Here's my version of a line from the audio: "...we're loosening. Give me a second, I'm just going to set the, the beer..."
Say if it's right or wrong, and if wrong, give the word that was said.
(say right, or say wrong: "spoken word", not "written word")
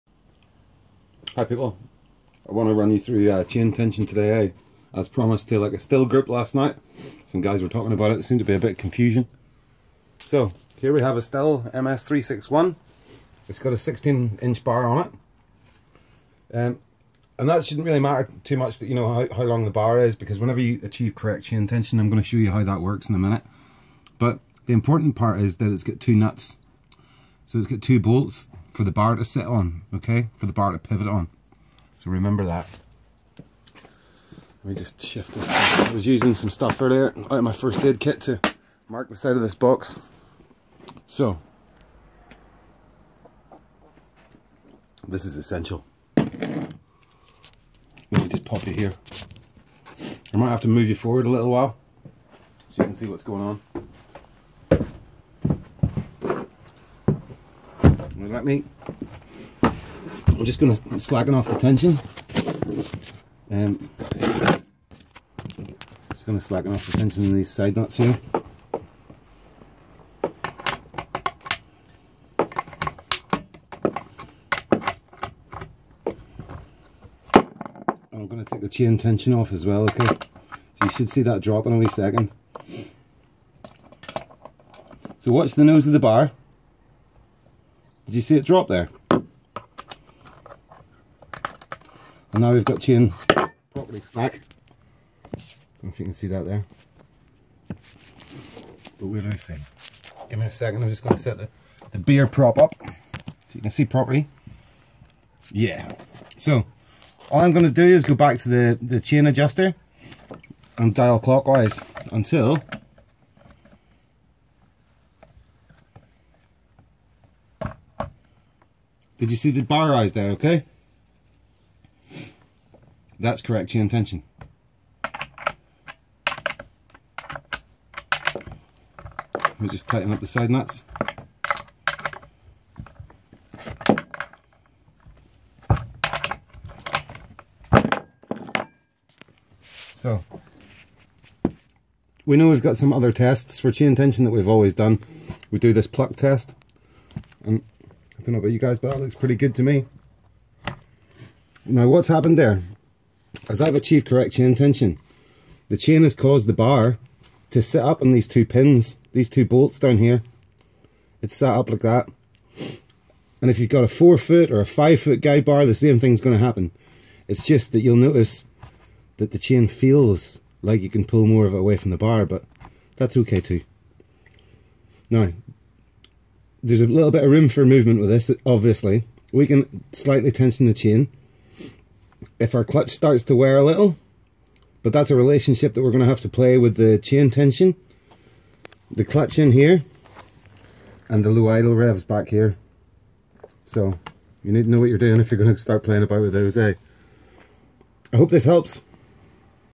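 right.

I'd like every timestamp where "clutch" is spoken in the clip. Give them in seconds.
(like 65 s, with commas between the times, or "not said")
182 s, 189 s.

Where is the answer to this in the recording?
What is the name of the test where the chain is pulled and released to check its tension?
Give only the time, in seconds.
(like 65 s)
145 s.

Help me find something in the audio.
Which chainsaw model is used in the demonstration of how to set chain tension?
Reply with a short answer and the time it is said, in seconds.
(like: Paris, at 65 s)
Stihl MS361, at 11 s.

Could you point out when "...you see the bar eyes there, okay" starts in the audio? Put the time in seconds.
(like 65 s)
119 s.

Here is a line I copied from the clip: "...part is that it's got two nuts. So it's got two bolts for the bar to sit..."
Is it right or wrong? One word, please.
right.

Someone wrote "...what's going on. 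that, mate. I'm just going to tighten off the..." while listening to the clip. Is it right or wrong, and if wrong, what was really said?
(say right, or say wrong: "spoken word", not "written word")
wrong: "slacken", not "tighten".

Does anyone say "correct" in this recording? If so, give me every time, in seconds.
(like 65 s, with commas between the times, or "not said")
21 s, 123 s, 154 s.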